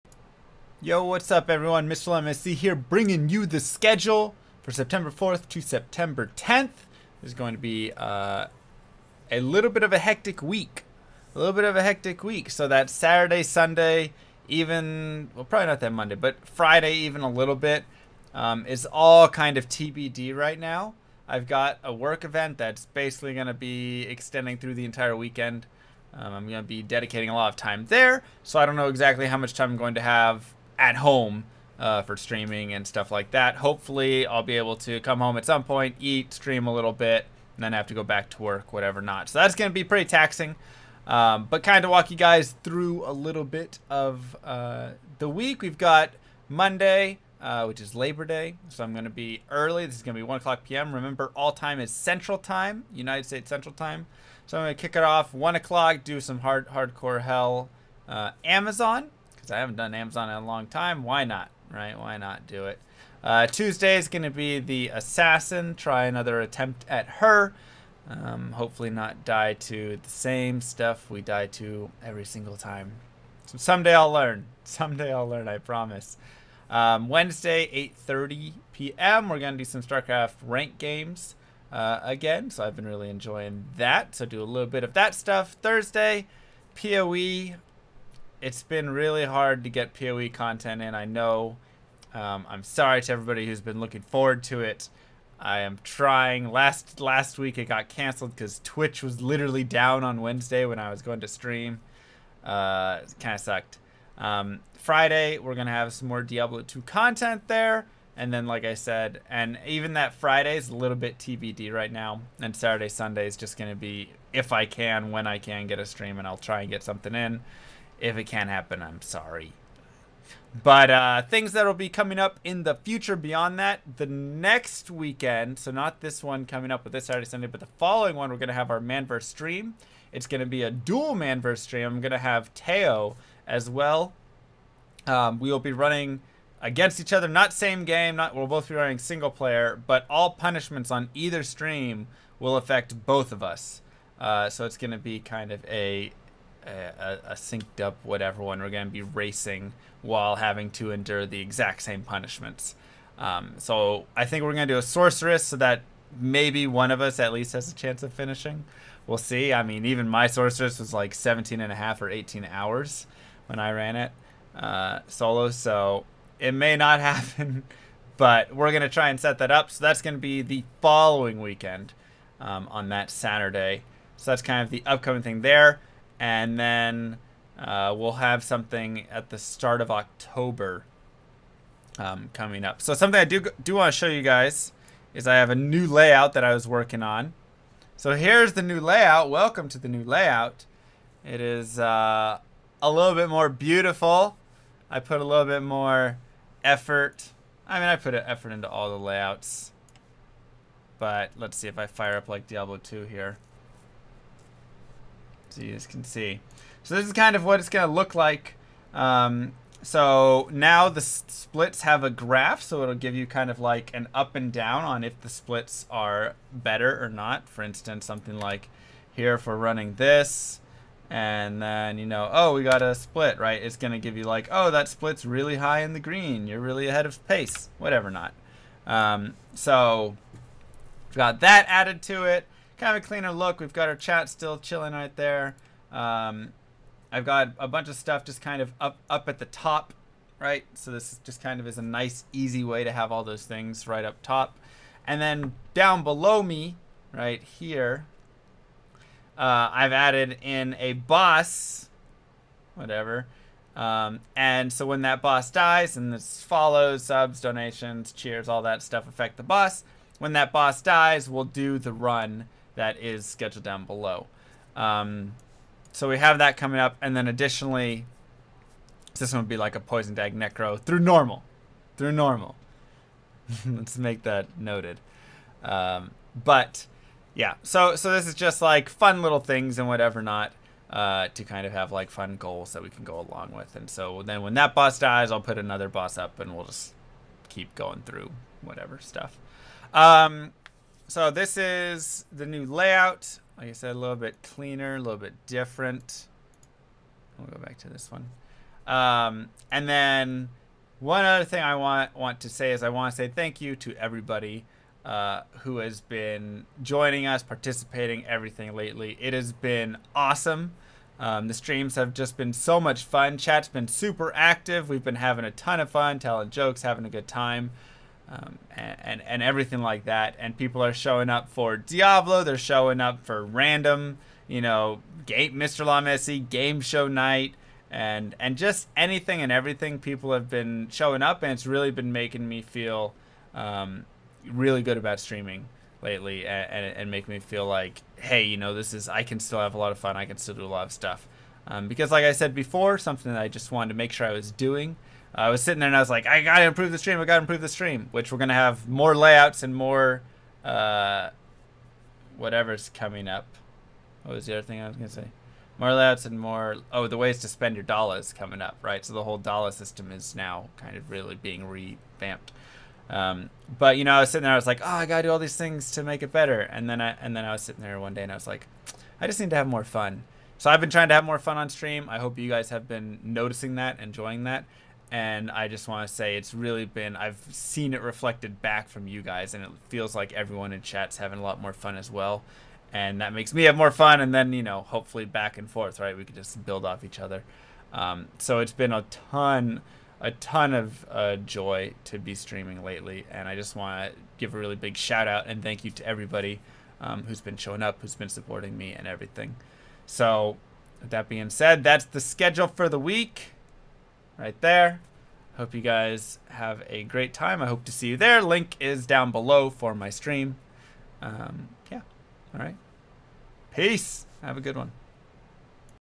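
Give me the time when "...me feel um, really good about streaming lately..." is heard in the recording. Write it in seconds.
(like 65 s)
332 s.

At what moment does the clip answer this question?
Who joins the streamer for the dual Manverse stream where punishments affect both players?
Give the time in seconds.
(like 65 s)
132 s.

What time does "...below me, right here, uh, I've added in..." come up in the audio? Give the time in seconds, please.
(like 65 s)
246 s.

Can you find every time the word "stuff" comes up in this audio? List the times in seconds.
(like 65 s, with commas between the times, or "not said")
32 s, 70 s, 85 s, 237 s, 258 s, 288 s, 340 s.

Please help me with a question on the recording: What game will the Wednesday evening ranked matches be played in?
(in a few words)
StarCraft.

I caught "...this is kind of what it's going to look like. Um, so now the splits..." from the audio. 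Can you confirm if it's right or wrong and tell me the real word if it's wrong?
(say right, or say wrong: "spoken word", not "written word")
right.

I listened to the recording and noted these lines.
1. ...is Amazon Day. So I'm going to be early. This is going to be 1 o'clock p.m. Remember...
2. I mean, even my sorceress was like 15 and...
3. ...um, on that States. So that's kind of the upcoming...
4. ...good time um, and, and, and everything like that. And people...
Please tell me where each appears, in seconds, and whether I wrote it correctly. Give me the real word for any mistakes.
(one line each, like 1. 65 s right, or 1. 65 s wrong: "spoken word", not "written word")
1. 47 s wrong: "Labor", not "Amazon"
2. 159 s wrong: "17", not "15"
3. 172 s wrong: "Saturday", not "States"
4. 317 s right.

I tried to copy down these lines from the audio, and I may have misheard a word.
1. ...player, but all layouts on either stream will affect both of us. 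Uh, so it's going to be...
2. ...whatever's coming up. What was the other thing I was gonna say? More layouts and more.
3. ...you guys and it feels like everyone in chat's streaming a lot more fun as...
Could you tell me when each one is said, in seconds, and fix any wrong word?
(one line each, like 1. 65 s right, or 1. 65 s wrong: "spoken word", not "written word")
1. 139 s wrong: "punishments", not "layouts"
2. 352 s right
3. 379 s wrong: "having", not "streaming".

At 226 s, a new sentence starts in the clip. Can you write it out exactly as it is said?
You're really ahead of pace, whatever not.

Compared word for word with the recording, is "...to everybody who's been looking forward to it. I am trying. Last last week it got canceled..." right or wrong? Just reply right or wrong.
right.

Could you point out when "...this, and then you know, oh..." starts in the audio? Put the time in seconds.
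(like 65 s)
219 s.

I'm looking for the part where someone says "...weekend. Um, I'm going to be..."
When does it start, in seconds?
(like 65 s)
25 s.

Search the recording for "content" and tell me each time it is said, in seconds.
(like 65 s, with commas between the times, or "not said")
90 s, 106 s.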